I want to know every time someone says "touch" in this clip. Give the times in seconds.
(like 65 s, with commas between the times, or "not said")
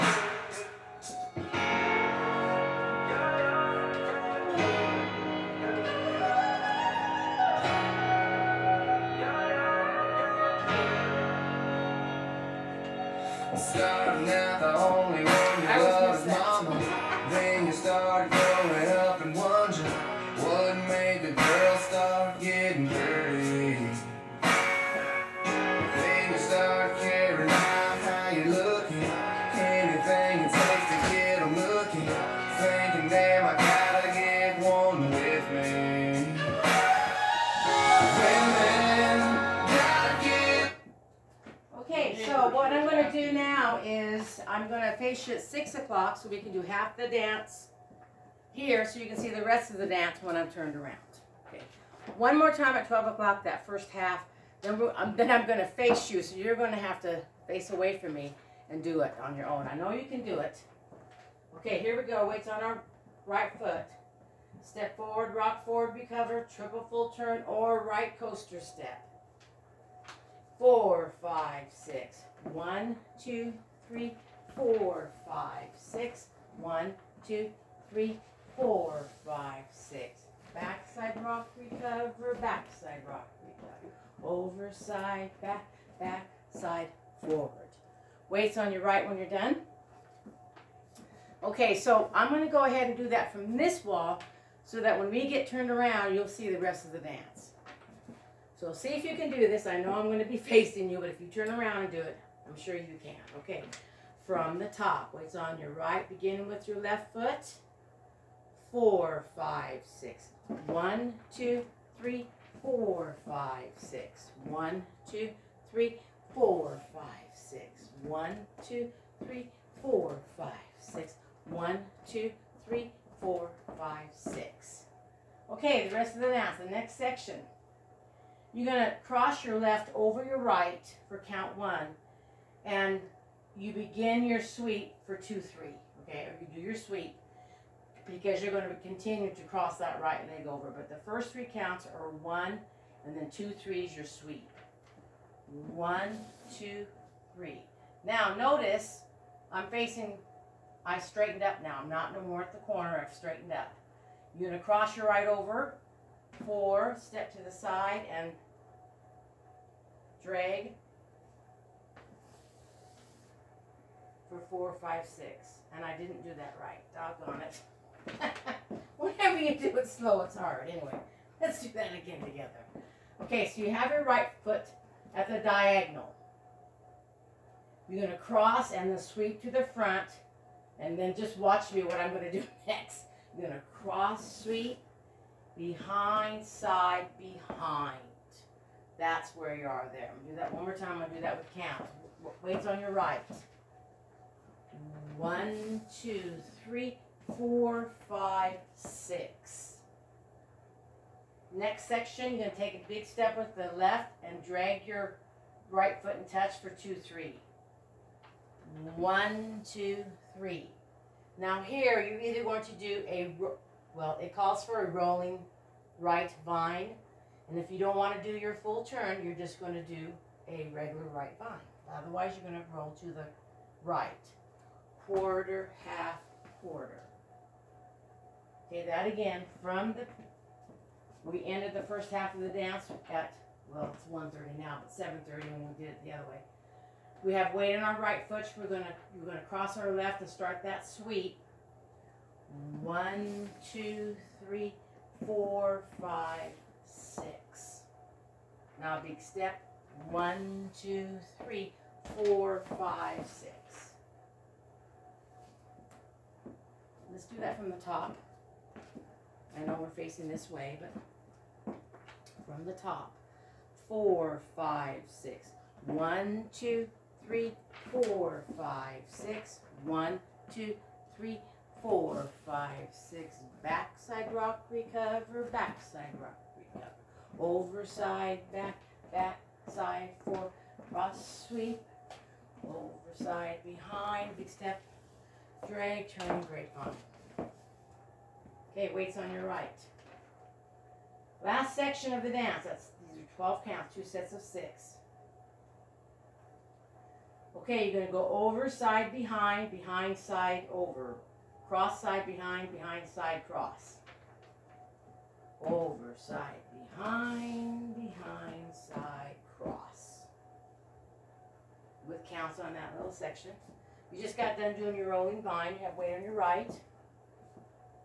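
206 s.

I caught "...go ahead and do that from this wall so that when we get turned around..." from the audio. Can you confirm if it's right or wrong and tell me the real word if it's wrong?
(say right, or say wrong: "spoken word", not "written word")
right.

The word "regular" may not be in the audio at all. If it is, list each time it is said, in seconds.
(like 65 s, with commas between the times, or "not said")
220 s.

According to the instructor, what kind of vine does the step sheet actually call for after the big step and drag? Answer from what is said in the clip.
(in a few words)
Rolling right vine.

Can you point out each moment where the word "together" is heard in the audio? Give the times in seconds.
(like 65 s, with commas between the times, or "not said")
172 s.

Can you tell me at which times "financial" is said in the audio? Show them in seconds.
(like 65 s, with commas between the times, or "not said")
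not said.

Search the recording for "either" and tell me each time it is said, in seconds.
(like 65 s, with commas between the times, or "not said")
212 s.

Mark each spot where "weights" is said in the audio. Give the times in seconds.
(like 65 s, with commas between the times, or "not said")
62 s, 88 s, 105 s, 192 s, 237 s, 288 s, 315 s.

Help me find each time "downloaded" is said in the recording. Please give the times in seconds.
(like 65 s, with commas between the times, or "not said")
not said.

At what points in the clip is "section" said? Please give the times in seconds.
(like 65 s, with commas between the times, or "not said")
126 s, 201 s, 291 s, 313 s.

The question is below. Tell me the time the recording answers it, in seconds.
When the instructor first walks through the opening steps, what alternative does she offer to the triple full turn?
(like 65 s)
67 s.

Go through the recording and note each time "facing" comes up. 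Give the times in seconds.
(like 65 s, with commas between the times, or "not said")
100 s, 149 s, 259 s.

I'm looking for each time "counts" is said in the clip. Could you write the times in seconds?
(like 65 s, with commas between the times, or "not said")
131 s, 141 s, 191 s, 293 s, 312 s.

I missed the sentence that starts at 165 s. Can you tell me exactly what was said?
And I didn't do that right.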